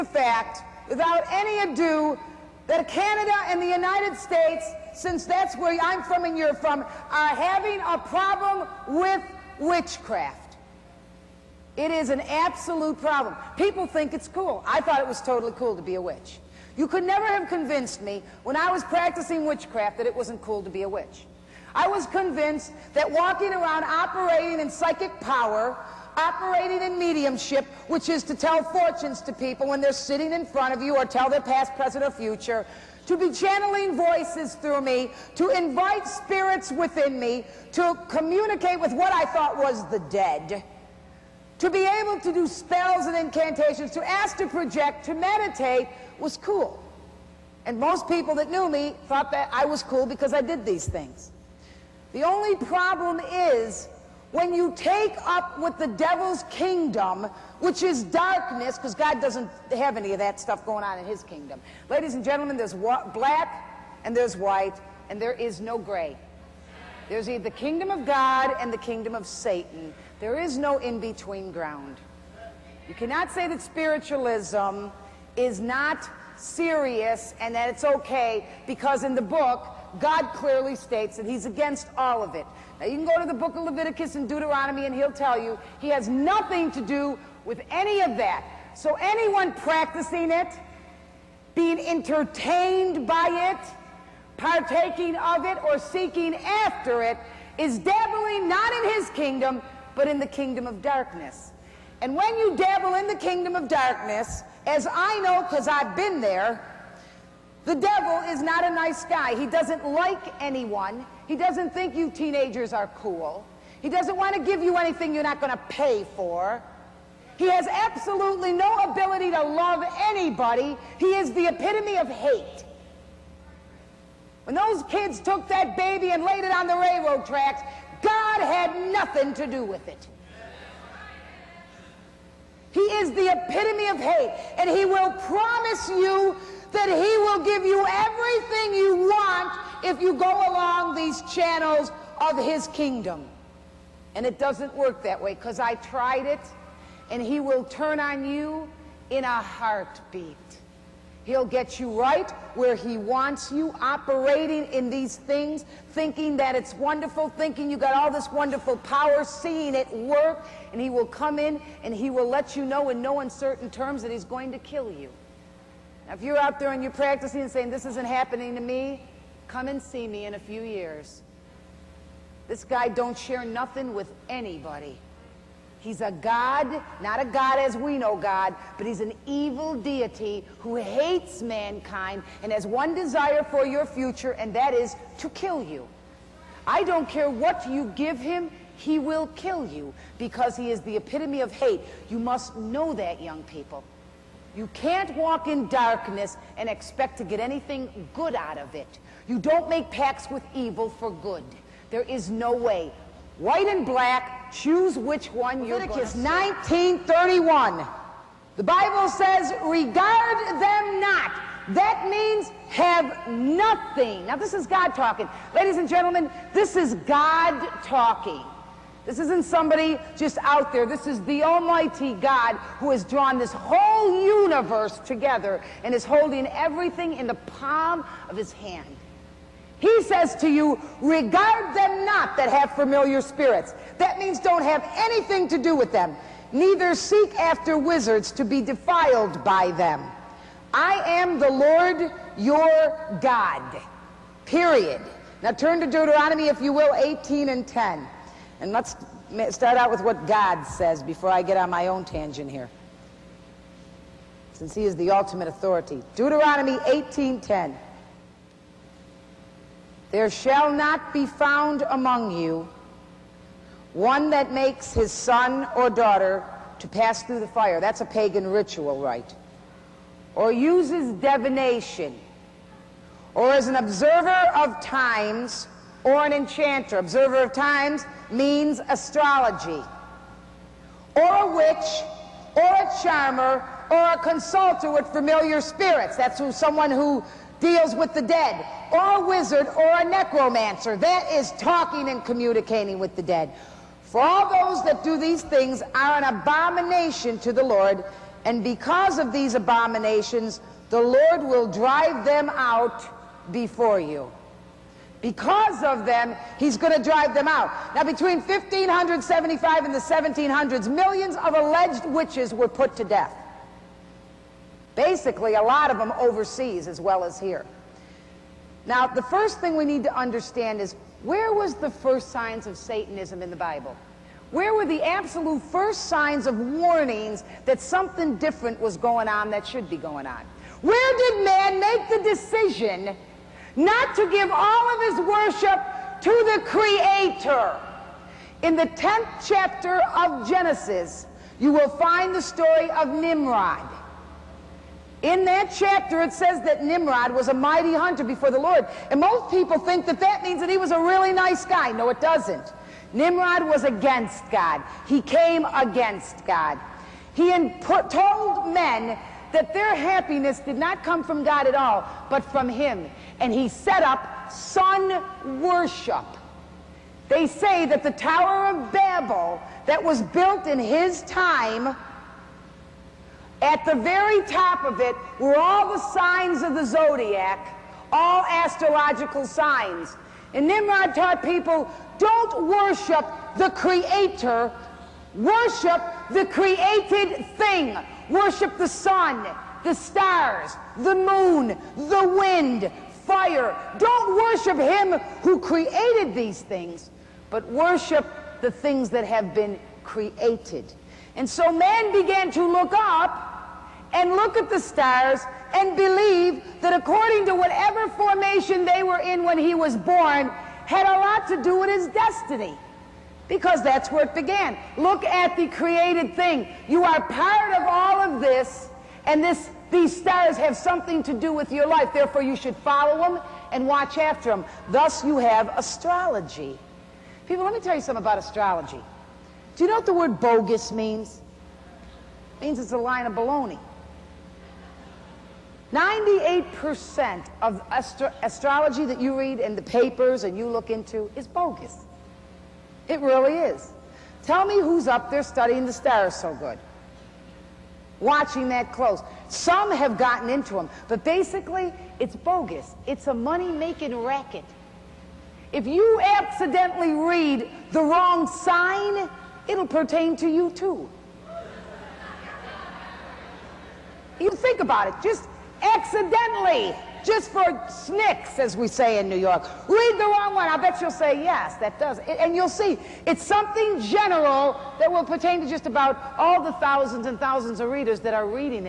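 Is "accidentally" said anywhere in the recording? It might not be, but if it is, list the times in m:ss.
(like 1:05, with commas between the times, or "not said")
7:36, 7:45.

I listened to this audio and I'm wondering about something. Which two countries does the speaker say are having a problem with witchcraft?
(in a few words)
Canada and the United States.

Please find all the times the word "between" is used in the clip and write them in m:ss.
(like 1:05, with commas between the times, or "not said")
1:10, 5:08.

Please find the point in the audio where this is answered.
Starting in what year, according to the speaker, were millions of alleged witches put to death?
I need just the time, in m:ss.
5:08.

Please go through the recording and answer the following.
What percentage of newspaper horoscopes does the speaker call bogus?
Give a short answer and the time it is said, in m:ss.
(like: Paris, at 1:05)
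98%, at 7:15.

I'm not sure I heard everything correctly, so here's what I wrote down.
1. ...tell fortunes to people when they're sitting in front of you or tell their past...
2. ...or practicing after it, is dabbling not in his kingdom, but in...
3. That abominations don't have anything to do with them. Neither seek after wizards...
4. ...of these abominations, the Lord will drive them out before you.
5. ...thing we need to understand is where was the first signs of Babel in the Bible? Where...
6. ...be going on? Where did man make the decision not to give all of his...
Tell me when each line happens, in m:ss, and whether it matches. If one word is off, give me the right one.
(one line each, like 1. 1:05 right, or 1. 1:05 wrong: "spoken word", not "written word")
1. 0:28 right
2. 1:35 wrong: "seeking", not "practicing"
3. 3:53 wrong: "means", not "abominations"
4. 4:59 right
5. 5:19 wrong: "Satanism", not "Babel"
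6. 5:29 right.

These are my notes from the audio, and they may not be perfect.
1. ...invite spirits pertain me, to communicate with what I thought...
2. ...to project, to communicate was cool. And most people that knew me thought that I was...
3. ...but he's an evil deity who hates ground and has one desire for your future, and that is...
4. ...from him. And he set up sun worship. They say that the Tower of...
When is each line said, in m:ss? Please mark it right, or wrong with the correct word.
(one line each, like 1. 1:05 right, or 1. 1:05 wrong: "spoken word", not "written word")
1. 0:35 wrong: "within", not "pertain"
2. 0:44 wrong: "meditate", not "communicate"
3. 2:58 wrong: "mankind", not "ground"
4. 6:02 right.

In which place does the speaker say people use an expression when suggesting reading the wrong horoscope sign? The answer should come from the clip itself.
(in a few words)
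New York.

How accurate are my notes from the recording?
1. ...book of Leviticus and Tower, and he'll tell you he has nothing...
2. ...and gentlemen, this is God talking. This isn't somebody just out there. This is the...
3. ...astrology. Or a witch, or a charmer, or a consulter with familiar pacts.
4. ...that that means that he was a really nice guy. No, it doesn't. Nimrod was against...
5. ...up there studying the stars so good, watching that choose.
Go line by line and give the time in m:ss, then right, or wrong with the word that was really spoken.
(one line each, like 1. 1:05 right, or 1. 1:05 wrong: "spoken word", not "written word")
1. 1:23 wrong: "Deuteronomy", not "Tower"
2. 3:35 right
3. 4:38 wrong: "spirits", not "pacts"
4. 5:50 right
5. 7:25 wrong: "close", not "choose".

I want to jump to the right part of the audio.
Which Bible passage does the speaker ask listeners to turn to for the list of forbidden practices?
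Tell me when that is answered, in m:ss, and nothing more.
4:16.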